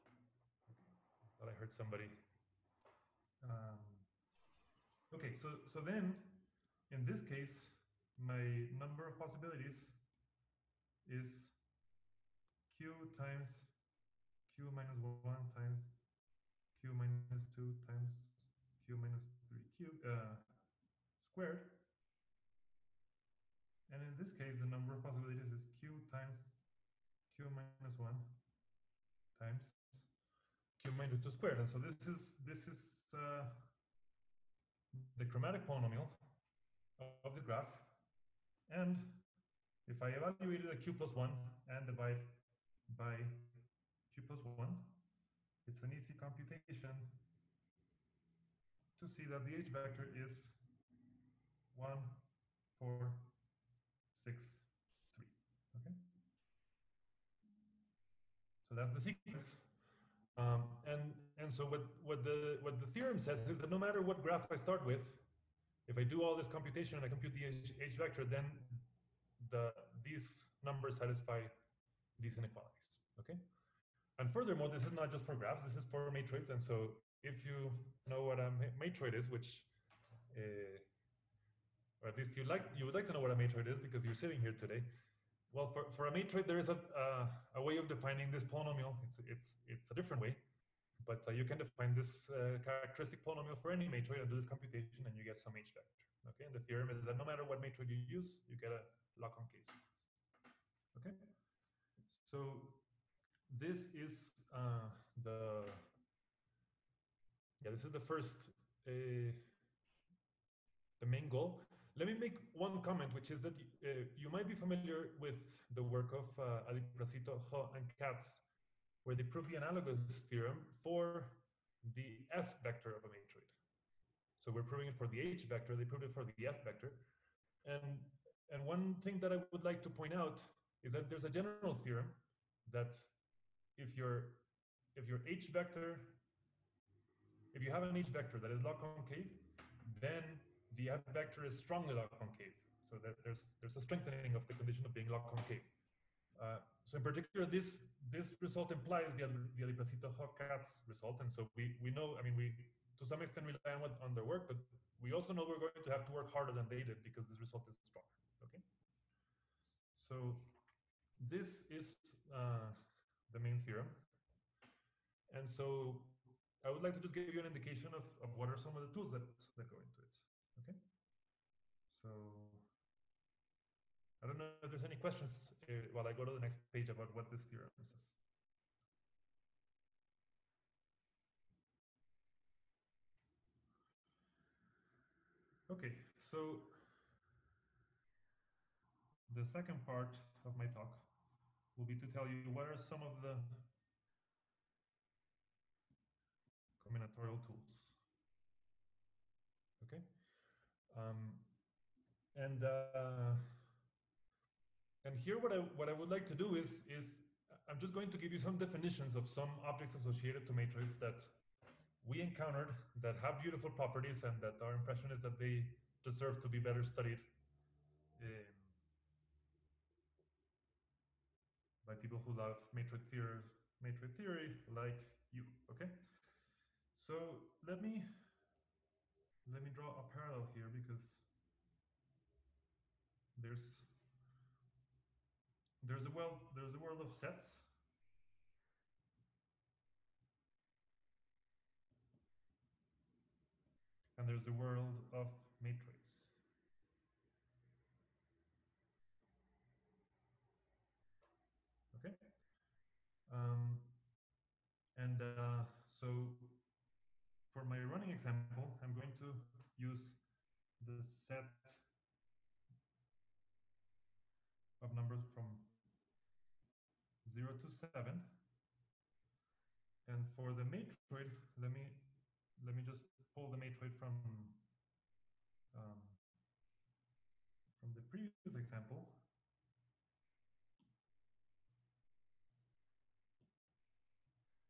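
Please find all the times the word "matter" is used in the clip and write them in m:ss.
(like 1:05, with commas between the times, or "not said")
1:03, 1:37.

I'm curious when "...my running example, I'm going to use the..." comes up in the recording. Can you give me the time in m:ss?
4:17.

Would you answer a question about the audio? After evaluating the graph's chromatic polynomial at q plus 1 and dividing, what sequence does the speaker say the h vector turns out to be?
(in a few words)
1, 4, 6, 3.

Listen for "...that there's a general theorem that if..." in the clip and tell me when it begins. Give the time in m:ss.
2:10.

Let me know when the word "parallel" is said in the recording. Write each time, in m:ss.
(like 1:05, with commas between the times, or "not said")
3:50.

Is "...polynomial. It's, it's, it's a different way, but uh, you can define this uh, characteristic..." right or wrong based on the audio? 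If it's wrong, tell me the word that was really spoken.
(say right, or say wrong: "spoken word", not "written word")
right.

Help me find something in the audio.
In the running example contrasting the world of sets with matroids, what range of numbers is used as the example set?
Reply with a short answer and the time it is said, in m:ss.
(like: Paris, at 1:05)
0 to 7, at 4:27.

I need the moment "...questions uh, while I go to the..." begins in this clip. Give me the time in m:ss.
2:54.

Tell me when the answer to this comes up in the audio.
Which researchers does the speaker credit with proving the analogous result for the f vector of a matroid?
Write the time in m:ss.
1:56.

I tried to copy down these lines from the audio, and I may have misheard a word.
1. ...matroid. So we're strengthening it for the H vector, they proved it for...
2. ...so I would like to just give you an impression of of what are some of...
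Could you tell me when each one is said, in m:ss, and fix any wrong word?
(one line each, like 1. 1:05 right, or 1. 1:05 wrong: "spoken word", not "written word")
1. 2:03 wrong: "proving", not "strengthening"
2. 2:45 wrong: "indication", not "impression".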